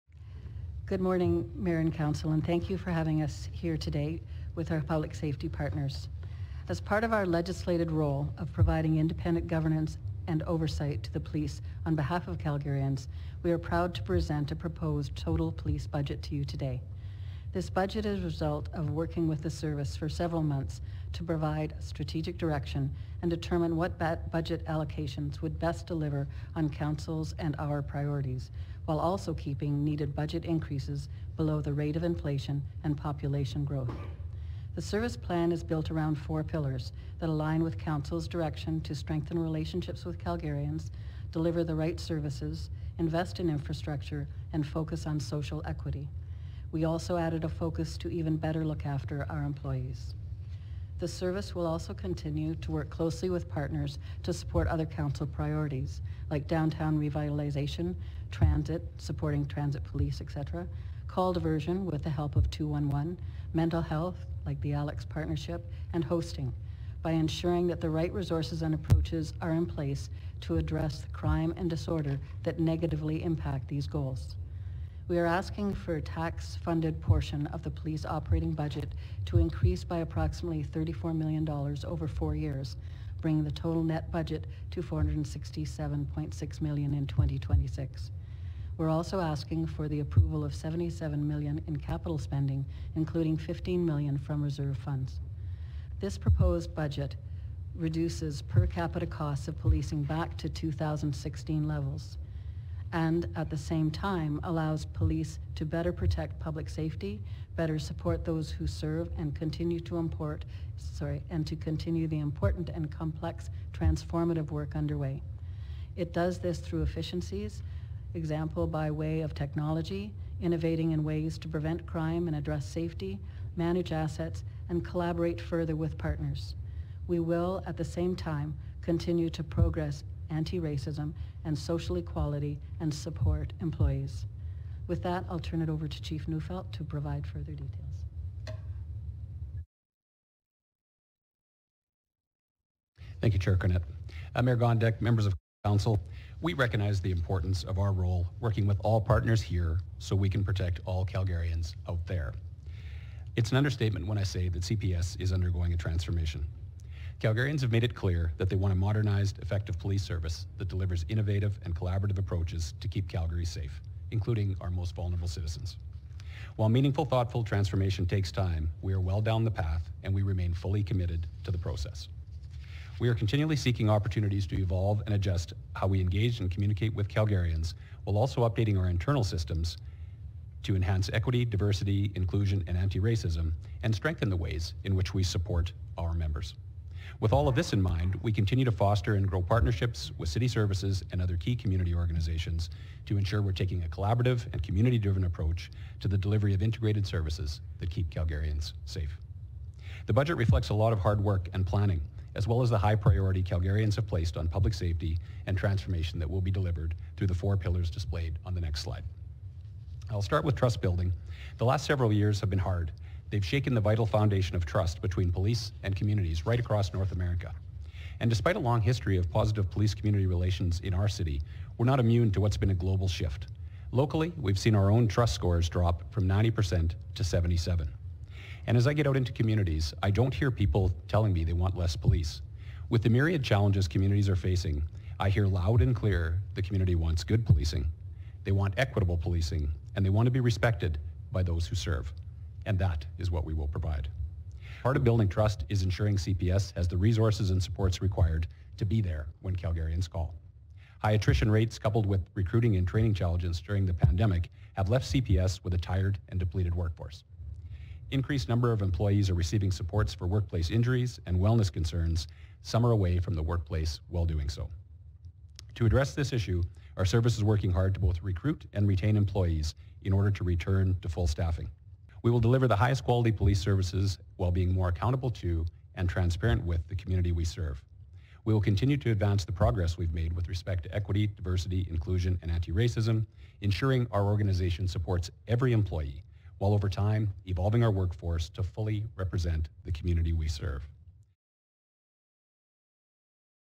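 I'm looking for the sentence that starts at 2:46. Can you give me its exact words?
While meaningful, thoughtful transformation takes time, we are well down the path and we remain fully committed to the process.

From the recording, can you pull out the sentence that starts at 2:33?
It's an understatement when I say that CPS is undergoing a transformation.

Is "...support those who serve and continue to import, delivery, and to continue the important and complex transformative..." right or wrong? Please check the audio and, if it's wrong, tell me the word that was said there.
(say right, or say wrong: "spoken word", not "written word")
wrong: "sorry", not "delivery".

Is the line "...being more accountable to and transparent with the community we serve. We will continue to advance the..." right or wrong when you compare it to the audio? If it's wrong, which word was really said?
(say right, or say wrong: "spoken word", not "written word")
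right.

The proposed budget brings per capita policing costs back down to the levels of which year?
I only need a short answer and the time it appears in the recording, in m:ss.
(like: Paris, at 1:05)
2016, at 1:40.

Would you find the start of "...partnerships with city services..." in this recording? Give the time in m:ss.
3:09.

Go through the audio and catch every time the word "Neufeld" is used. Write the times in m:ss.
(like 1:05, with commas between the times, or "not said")
2:16.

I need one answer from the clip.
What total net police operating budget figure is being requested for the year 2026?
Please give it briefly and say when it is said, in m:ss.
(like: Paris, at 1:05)
$467.6 million, at 1:24.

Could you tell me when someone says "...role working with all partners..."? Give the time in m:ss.
2:27.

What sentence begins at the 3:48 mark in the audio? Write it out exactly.
And as I get out into communities, I don't hear people telling me they want less police.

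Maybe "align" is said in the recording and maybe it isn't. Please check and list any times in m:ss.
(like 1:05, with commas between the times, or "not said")
0:37.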